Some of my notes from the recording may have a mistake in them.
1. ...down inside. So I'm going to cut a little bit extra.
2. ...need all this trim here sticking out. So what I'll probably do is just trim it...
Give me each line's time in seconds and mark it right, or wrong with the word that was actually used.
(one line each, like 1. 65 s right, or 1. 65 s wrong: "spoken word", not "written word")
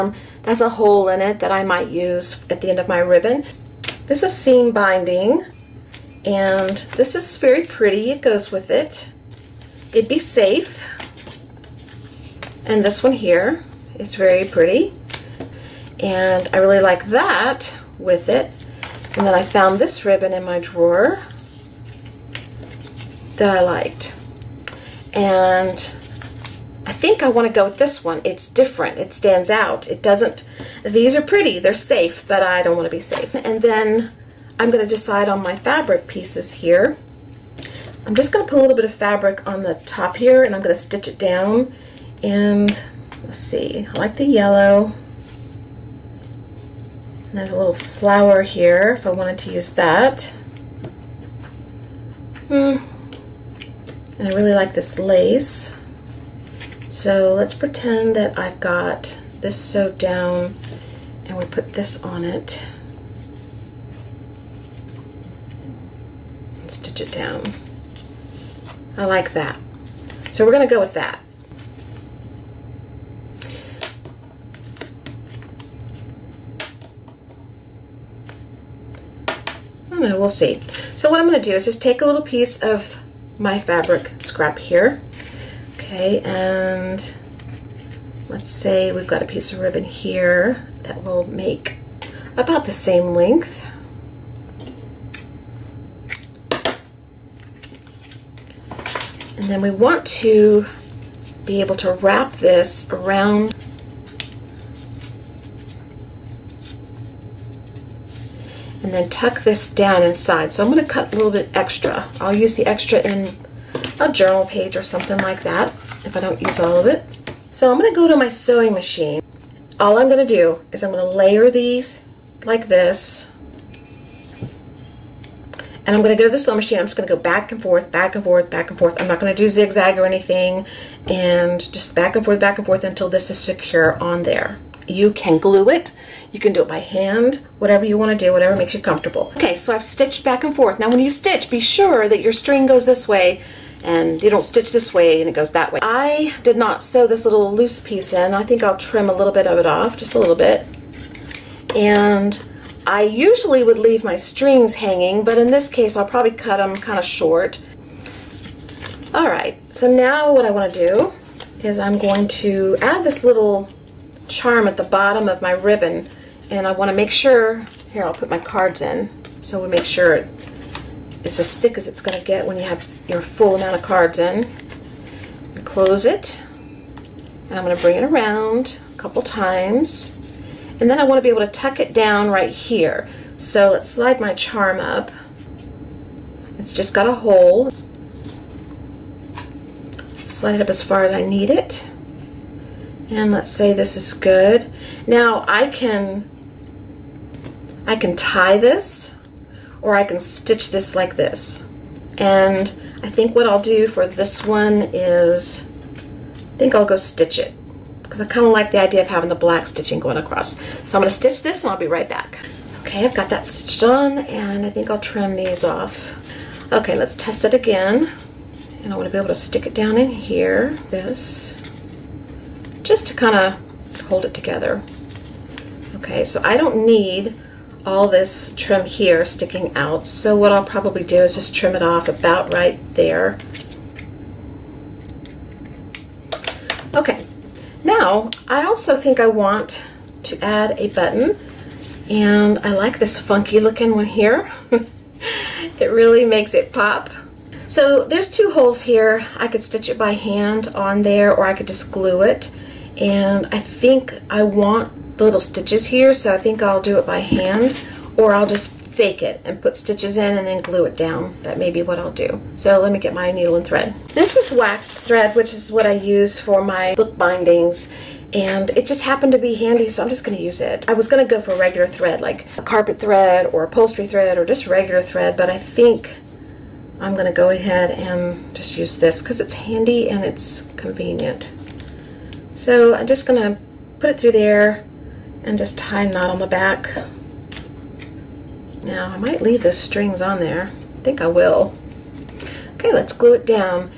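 1. 109 s right
2. 226 s right.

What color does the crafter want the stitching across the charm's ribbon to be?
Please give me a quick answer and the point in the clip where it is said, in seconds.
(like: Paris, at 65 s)
Black, at 209 s.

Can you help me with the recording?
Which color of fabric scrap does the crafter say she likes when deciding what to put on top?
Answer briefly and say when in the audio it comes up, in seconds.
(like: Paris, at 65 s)
Yellow, at 44 s.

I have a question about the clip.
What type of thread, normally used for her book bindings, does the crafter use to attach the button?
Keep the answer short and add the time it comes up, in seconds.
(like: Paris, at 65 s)
Waxed thread, at 264 s.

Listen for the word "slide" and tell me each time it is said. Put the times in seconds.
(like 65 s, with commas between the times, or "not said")
183 s, 190 s.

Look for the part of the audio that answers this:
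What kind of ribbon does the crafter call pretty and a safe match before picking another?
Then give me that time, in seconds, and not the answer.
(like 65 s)
4 s.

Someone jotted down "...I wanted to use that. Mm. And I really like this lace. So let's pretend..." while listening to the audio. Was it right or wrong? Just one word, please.
right.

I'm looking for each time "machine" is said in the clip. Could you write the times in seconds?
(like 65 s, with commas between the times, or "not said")
118 s, 126 s.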